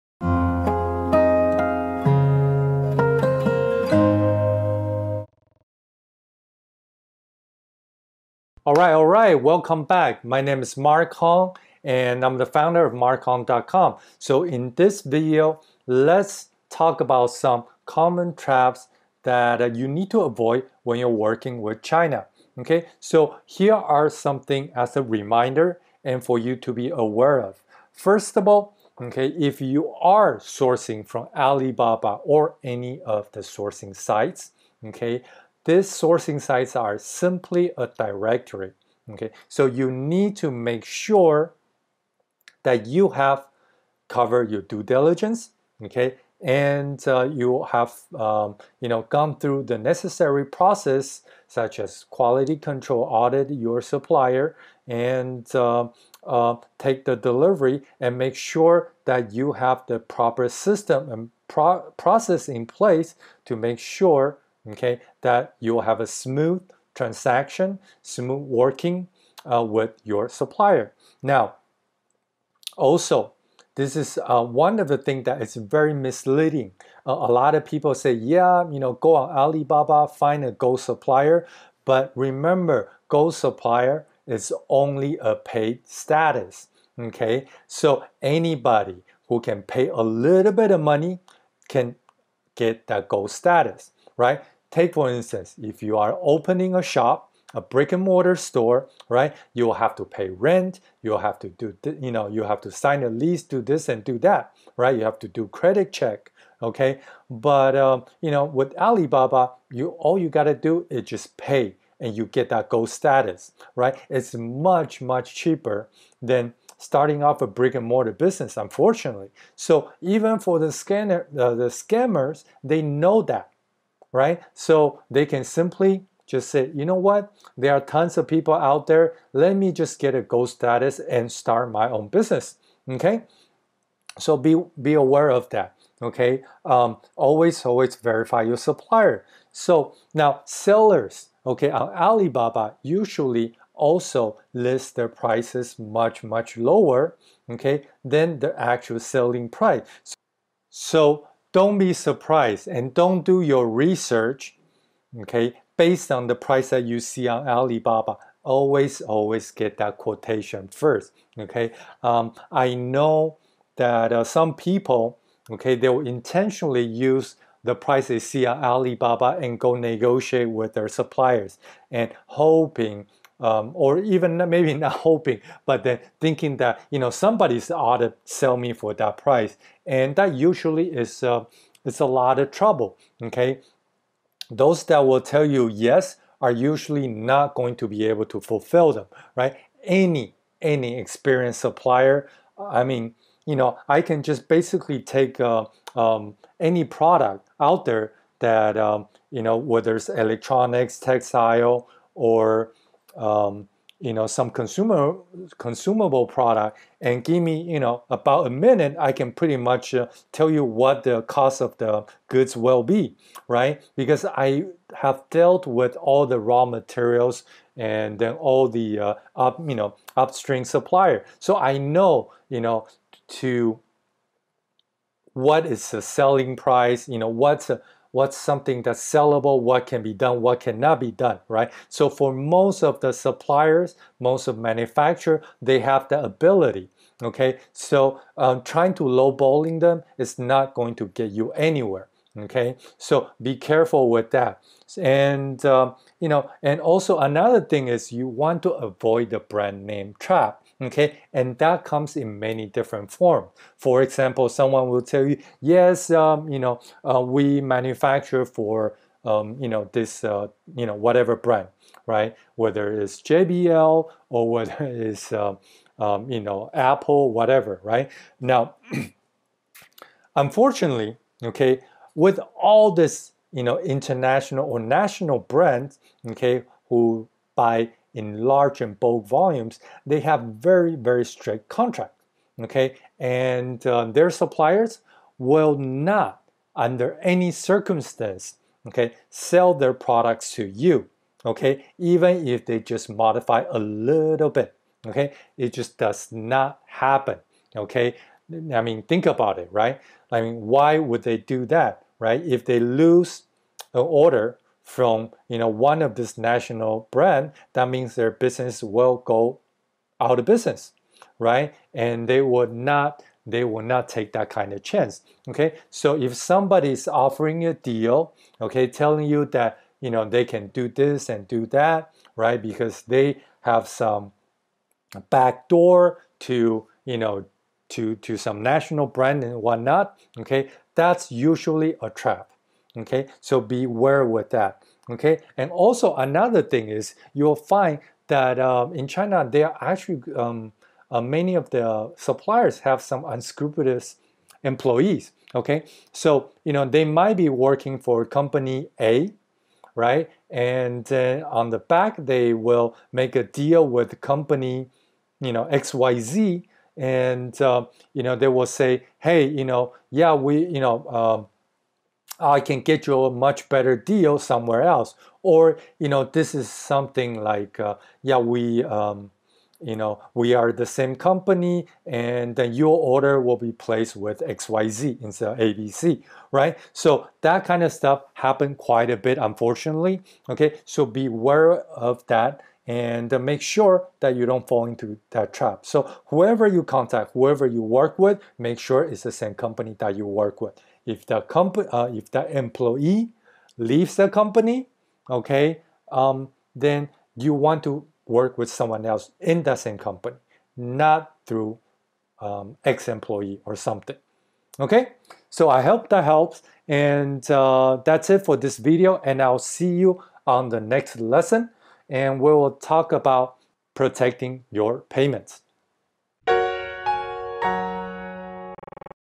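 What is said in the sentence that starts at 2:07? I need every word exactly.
There are tons of people out there.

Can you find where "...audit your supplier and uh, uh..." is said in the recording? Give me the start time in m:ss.
0:53.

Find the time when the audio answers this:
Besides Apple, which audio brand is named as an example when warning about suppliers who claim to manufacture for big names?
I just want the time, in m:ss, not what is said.
4:23.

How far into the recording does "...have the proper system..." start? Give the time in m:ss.
0:59.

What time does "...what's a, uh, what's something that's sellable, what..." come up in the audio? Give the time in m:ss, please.
3:47.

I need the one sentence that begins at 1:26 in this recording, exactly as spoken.
Okay, so anybody who can pay a little bit of money can get that gold status, right?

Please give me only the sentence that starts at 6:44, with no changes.
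Okay, so I hope that helps, and uh, that's it for this video.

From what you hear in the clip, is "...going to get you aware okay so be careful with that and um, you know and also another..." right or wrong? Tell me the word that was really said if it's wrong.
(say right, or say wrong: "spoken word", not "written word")
wrong: "anywhere", not "aware".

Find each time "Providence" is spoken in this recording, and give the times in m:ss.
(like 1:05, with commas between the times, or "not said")
not said.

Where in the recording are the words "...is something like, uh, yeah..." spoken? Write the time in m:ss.
6:06.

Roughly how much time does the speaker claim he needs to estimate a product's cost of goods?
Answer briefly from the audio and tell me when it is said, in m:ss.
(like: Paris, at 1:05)
about a minute, at 3:28.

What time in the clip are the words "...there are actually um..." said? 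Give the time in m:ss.
5:39.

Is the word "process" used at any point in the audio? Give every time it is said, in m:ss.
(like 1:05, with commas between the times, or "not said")
0:50, 1:01.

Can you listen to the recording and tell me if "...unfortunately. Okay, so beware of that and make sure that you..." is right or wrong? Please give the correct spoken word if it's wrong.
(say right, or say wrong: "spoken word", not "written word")
right.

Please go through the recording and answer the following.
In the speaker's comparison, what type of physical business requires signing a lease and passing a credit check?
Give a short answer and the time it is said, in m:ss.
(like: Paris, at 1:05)
brick and mortar store, at 1:37.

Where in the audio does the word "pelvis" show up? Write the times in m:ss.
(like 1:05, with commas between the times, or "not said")
not said.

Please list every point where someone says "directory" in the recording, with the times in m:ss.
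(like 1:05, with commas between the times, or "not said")
0:37.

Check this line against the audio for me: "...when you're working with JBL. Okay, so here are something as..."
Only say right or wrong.
wrong.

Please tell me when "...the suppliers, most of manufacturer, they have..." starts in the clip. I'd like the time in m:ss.
3:52.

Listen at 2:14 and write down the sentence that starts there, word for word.
So be, be aware of that, okay?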